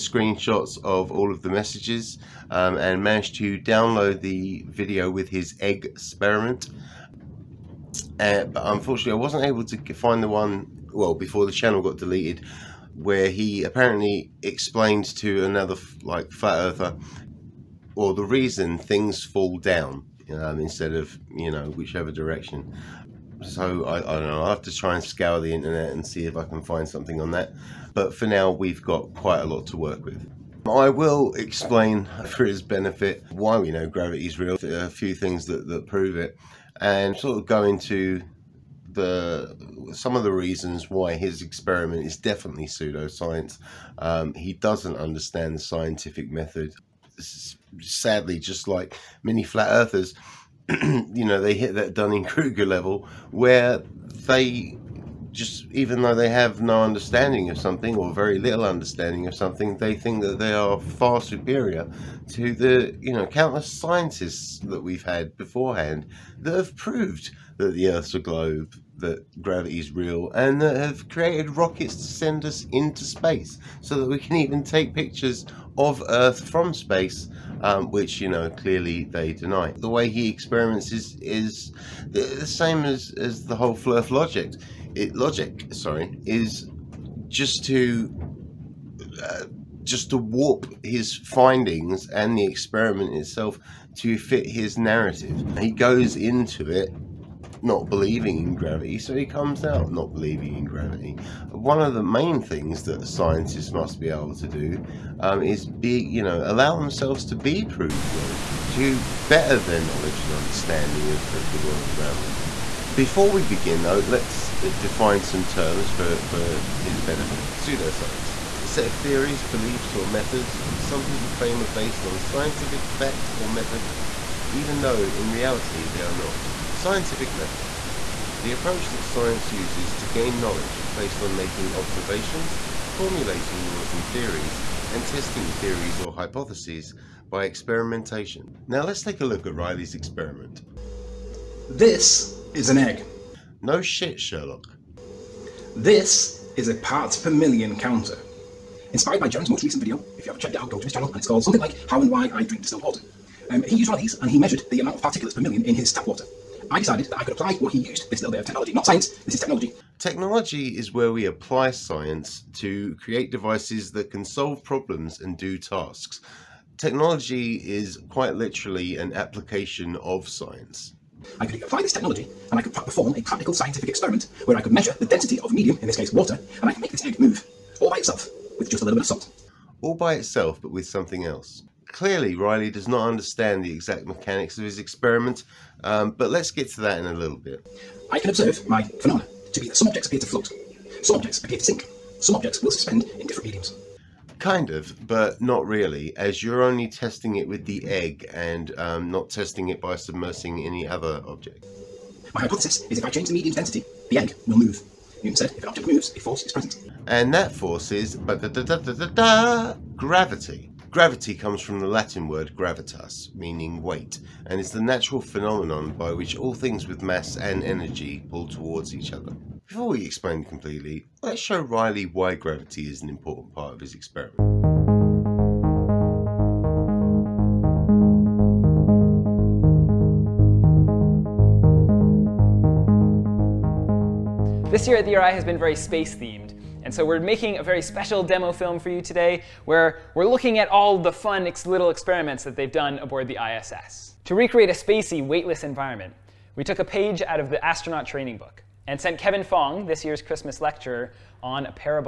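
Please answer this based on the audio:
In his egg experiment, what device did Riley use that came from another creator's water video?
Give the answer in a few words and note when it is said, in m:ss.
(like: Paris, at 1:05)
parts per million counter, at 2:26.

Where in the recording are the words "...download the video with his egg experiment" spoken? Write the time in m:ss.
0:03.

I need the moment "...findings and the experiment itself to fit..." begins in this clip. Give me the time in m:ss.
1:31.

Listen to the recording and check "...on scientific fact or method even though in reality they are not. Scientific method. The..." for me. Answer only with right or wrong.
right.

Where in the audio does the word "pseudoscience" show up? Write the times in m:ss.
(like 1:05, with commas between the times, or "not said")
0:42, 1:57.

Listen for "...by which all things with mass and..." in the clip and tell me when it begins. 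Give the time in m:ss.
3:35.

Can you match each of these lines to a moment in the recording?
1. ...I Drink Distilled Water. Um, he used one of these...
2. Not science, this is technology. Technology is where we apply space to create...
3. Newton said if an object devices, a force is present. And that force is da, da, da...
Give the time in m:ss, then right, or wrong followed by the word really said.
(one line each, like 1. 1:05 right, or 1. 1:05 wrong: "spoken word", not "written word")
1. 2:32 right
2. 2:38 wrong: "science", not "space"
3. 3:25 wrong: "moves", not "devices".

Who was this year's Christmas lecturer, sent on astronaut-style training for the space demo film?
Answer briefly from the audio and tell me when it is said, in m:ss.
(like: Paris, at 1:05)
Kevin Fong, at 4:09.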